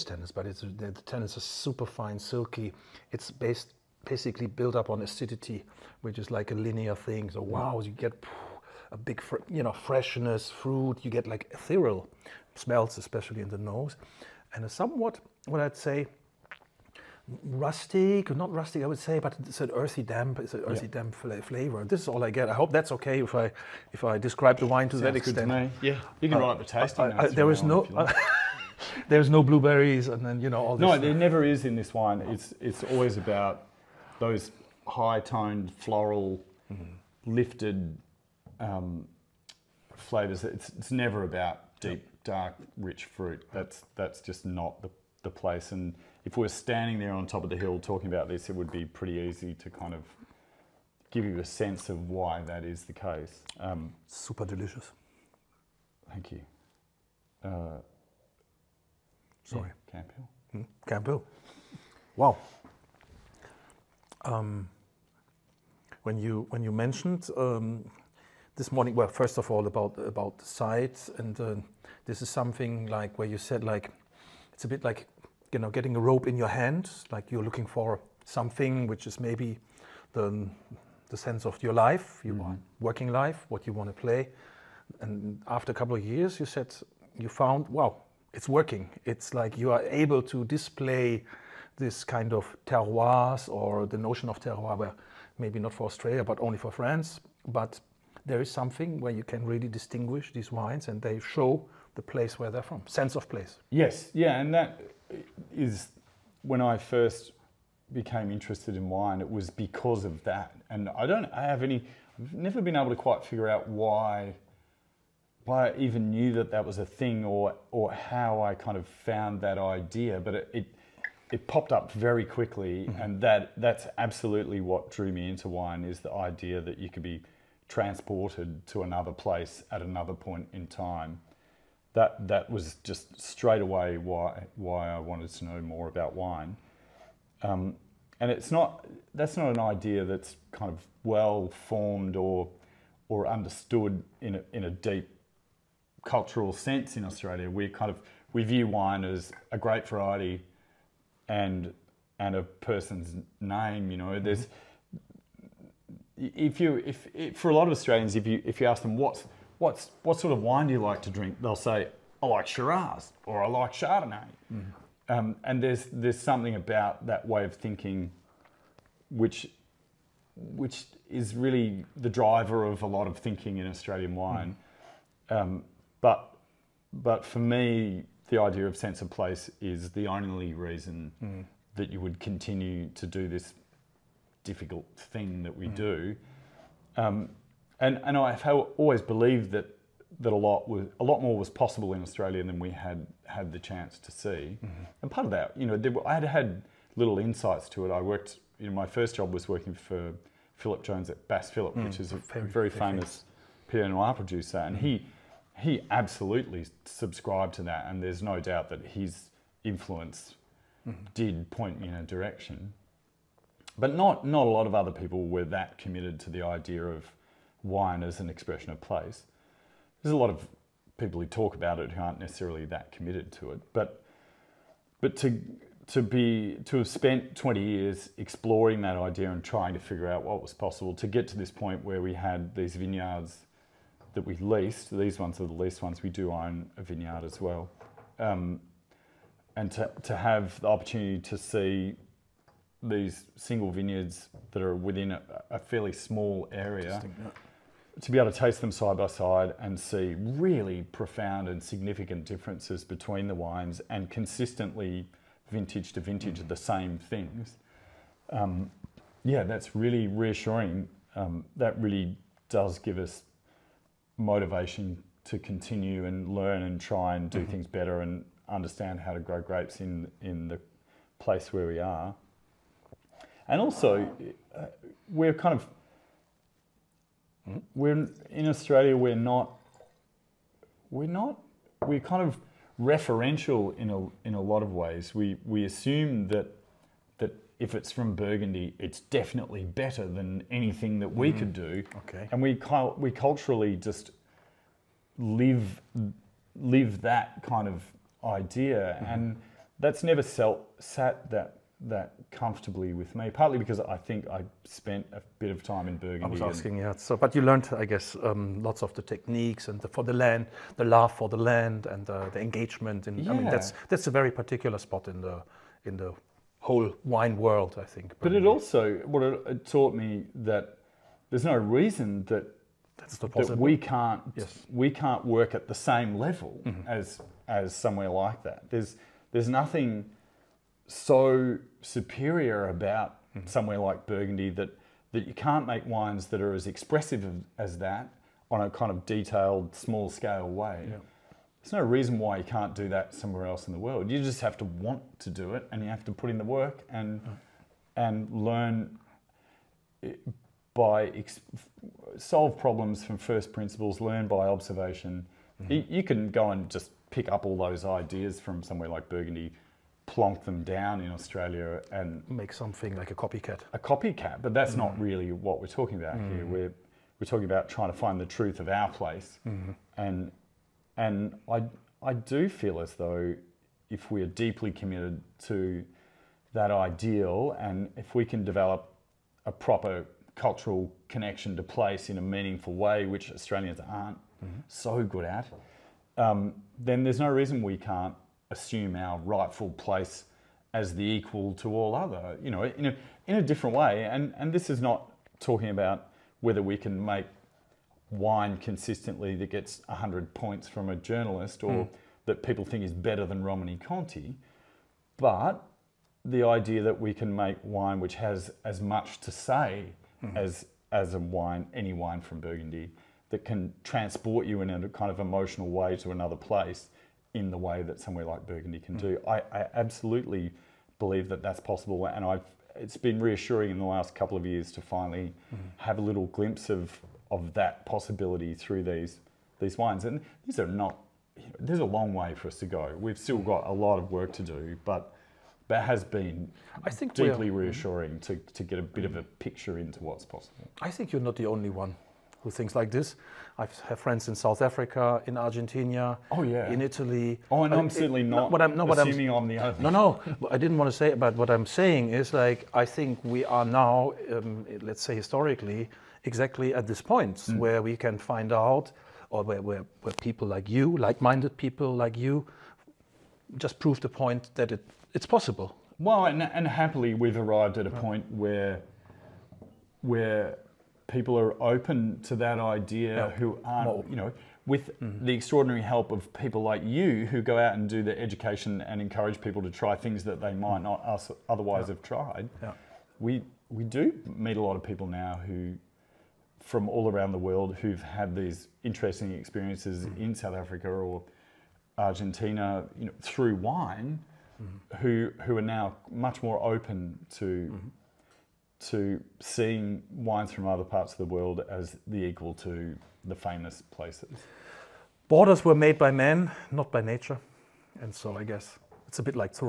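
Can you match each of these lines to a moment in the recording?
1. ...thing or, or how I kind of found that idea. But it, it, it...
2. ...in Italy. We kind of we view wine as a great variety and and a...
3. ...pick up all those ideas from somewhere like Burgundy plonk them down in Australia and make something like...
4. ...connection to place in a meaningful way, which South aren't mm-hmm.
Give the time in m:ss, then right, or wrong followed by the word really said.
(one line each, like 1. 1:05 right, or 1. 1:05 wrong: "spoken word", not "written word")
1. 1:56 right
2. 2:26 wrong: "Australia", not "Italy"
3. 5:57 right
4. 6:21 wrong: "Australians", not "South".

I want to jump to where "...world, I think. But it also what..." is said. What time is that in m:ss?
5:17.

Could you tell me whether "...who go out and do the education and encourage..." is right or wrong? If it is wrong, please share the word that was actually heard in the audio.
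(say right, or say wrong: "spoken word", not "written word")
right.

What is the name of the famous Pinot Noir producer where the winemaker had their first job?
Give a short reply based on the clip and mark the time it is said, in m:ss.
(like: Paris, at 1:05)
Bass Phillip, at 3:21.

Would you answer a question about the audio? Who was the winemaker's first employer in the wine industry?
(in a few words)
Phillip Jones.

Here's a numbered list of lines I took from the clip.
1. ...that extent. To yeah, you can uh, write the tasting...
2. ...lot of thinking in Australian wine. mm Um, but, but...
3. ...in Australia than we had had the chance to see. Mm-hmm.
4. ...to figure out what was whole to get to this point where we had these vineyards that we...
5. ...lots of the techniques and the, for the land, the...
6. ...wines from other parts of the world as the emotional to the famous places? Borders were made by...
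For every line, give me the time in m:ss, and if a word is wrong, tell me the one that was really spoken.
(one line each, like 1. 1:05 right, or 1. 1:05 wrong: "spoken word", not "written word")
1. 0:25 right
2. 2:52 right
3. 3:11 right
4. 3:49 wrong: "possible", not "whole"
5. 5:08 right
6. 8:20 wrong: "equal", not "emotional".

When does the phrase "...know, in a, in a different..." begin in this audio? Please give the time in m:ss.
6:32.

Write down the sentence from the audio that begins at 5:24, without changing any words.
we can't work at the same level mm-hmm.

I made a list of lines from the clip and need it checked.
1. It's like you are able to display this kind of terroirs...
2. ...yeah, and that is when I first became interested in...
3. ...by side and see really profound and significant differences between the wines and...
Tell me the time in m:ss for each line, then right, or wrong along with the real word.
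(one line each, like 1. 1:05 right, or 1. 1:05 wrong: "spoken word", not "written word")
1. 1:29 right
2. 1:44 right
3. 4:08 right.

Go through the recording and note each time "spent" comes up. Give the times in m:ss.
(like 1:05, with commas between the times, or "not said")
3:46, 5:04.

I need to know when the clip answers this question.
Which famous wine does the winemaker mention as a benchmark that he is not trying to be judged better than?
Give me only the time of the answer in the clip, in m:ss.
6:43.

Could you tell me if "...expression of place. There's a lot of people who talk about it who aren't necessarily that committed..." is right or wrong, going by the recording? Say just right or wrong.
right.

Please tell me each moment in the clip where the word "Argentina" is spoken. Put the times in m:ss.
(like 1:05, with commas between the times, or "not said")
7:25, 8:11.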